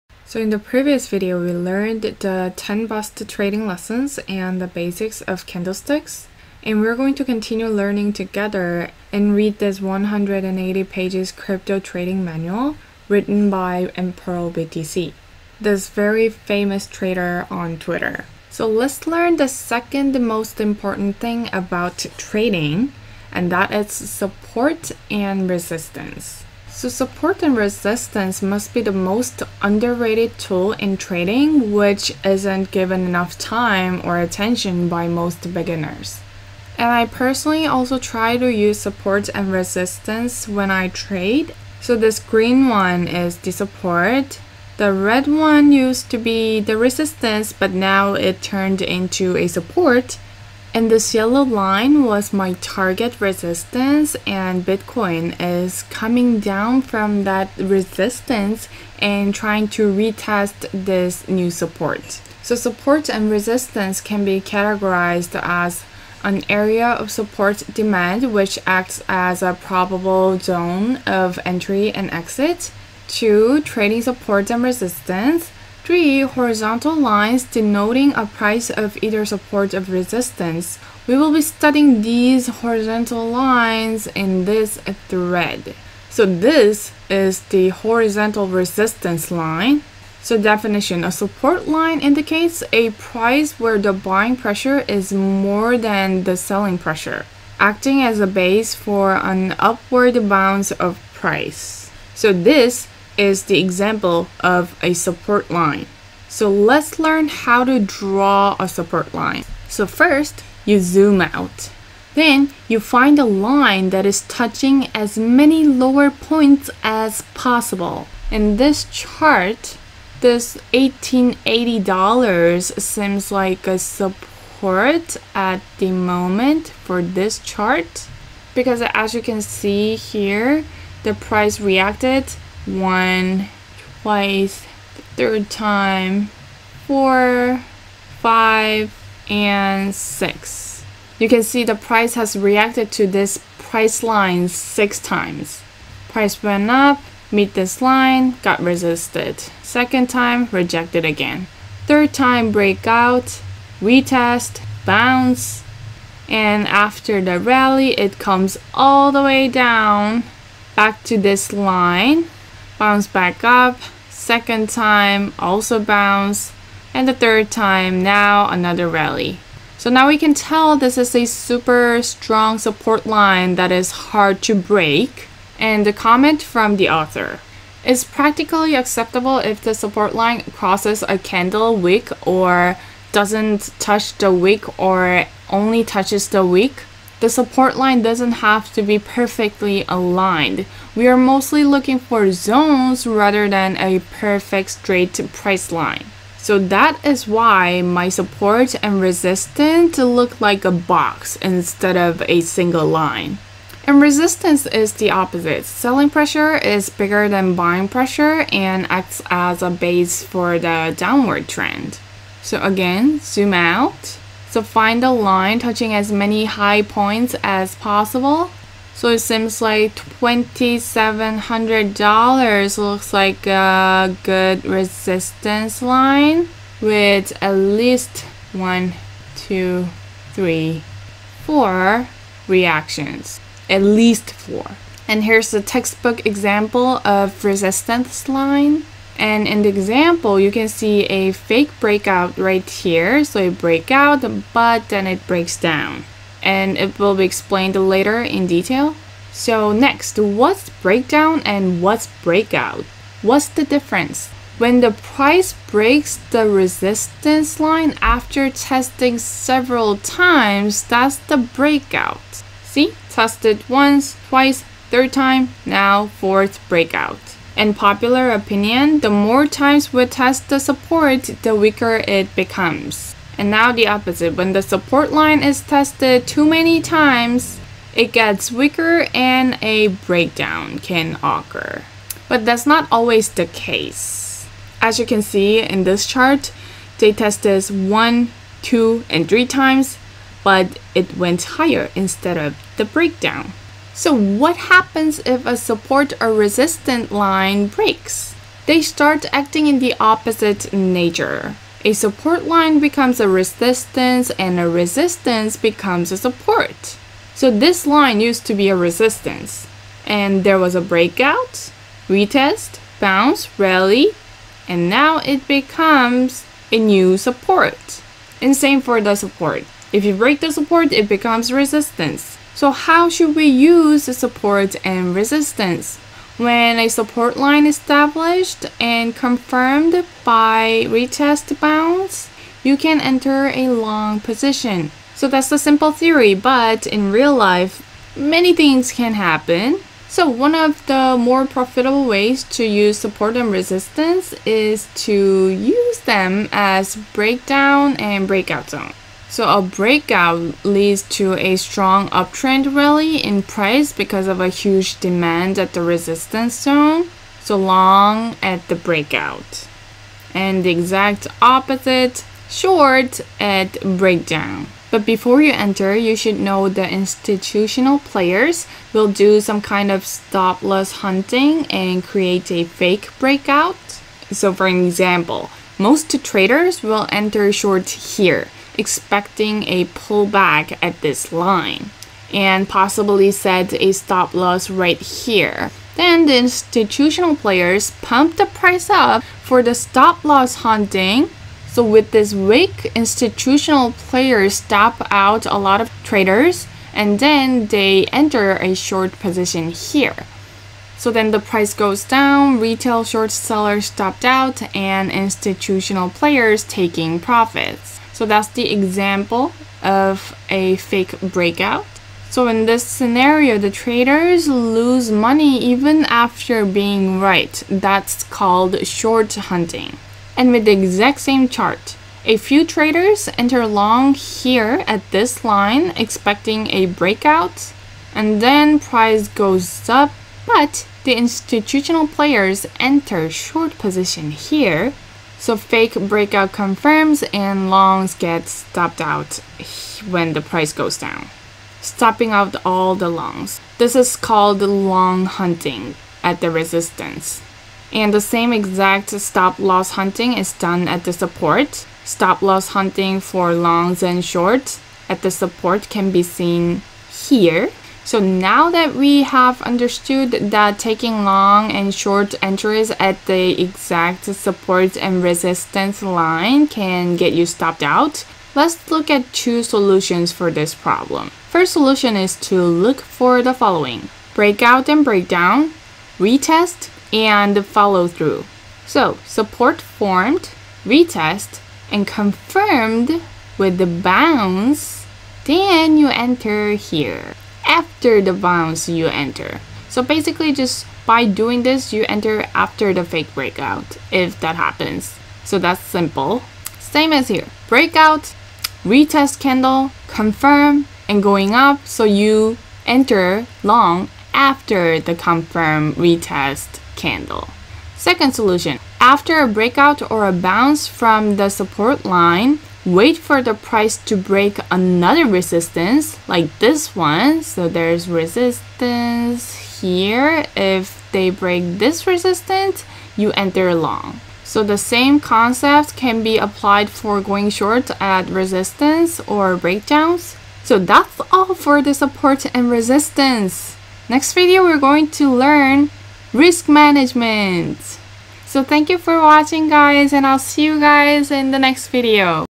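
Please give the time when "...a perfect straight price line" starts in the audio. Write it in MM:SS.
03:13.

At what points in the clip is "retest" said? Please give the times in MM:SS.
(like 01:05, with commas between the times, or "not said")
00:59, 02:33, 05:12, 05:30, 07:56, 08:00, 08:18, 08:25.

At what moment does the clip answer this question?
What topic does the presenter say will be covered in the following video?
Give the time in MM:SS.
08:56.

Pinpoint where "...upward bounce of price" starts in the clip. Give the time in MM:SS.
01:39.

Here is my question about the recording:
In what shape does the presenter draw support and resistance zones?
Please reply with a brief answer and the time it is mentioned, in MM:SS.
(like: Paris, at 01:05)
A box, at 03:20.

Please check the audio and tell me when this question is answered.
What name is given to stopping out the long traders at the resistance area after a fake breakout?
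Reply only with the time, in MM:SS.
07:24.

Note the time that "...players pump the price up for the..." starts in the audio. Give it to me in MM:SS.
06:27.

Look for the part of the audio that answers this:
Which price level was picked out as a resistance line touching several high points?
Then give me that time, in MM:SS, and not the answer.
03:39.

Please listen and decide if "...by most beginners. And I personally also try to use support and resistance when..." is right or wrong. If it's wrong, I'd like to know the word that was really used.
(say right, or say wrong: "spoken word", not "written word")
right.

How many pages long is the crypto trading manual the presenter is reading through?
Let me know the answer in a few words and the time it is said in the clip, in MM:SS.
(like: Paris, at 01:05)
180, at 00:09.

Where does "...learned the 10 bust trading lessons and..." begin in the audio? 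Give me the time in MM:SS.
00:01.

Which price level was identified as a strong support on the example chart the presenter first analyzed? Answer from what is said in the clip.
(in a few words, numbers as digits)
$1880.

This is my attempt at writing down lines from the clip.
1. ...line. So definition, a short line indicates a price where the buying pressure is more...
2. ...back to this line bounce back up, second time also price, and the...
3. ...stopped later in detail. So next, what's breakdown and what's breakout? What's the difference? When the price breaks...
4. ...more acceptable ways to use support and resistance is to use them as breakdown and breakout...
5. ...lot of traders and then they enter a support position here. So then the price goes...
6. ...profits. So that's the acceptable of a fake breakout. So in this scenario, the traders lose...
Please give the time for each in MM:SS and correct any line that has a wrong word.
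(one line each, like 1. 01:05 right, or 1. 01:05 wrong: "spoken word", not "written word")
1. 01:29 wrong: "support", not "short"
2. 02:40 wrong: "bounce", not "price"
3. 04:07 wrong: "explained", not "stopped"
4. 05:41 wrong: "profitable", not "acceptable"
5. 06:35 wrong: "short", not "support"
6. 06:47 wrong: "example", not "acceptable".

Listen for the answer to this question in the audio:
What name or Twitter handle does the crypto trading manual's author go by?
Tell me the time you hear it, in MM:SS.
00:13.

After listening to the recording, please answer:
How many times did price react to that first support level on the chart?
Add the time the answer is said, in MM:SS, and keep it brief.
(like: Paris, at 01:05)
6, at 02:24.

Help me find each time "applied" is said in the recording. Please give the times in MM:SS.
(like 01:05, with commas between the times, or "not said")
08:46.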